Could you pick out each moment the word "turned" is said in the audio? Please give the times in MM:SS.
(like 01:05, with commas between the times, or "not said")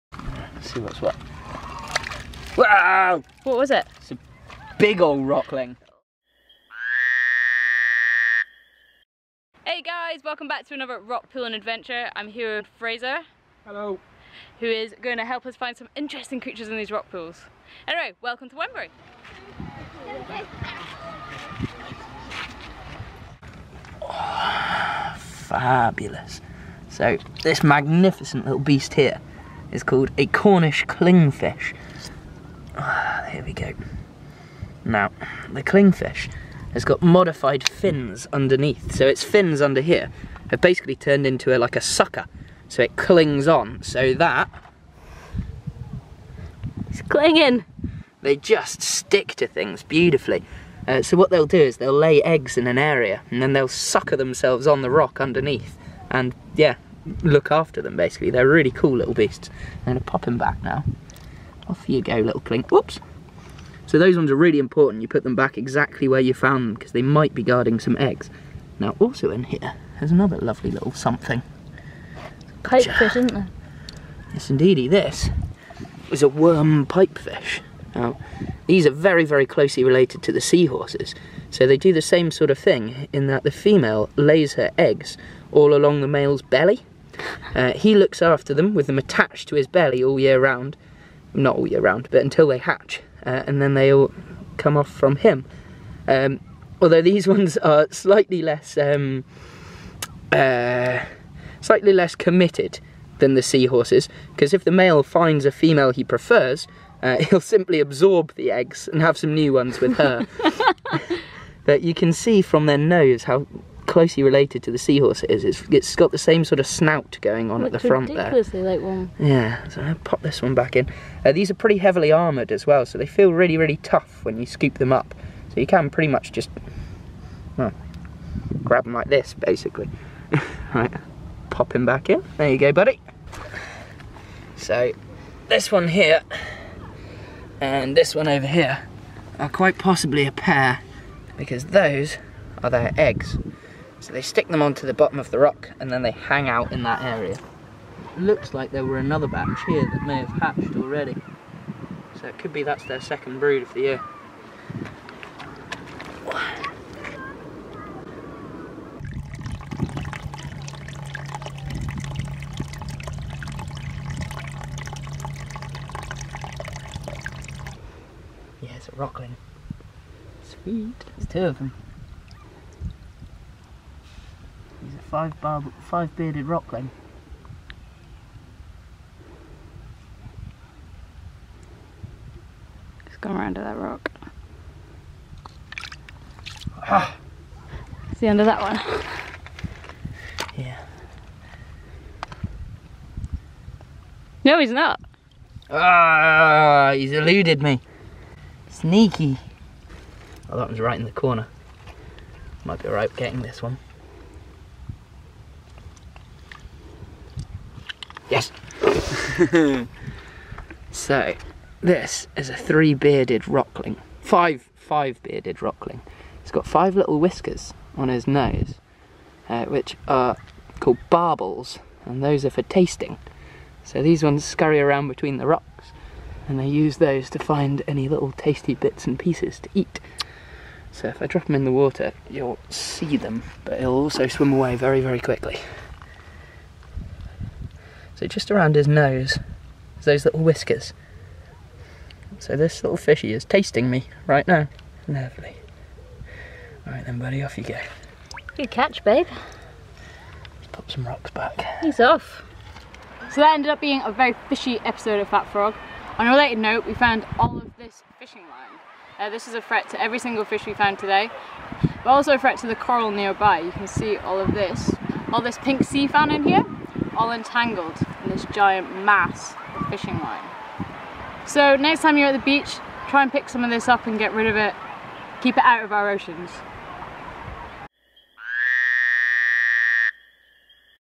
00:40.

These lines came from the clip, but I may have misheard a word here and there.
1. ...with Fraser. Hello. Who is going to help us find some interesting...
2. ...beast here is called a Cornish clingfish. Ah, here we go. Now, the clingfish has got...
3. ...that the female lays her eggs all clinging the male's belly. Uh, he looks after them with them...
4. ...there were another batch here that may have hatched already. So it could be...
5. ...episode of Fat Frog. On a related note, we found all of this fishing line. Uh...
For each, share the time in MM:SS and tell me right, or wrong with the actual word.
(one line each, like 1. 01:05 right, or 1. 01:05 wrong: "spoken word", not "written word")
1. 00:12 right
2. 00:28 right
3. 01:23 wrong: "along", not "clinging"
4. 02:28 right
5. 04:14 right.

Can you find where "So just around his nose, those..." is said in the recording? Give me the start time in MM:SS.
03:58.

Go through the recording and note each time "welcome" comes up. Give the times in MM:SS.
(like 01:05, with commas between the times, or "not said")
00:10, 00:18.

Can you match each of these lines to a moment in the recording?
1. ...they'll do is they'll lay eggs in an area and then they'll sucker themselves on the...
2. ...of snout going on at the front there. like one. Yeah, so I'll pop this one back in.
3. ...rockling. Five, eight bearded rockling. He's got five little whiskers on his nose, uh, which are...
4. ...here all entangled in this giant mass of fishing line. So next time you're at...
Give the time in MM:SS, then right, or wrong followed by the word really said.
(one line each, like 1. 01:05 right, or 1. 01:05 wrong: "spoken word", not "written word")
1. 00:51 right
2. 01:56 right
3. 03:33 wrong: "five", not "eight"
4. 04:26 right.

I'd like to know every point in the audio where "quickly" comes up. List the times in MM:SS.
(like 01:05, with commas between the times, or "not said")
03:55.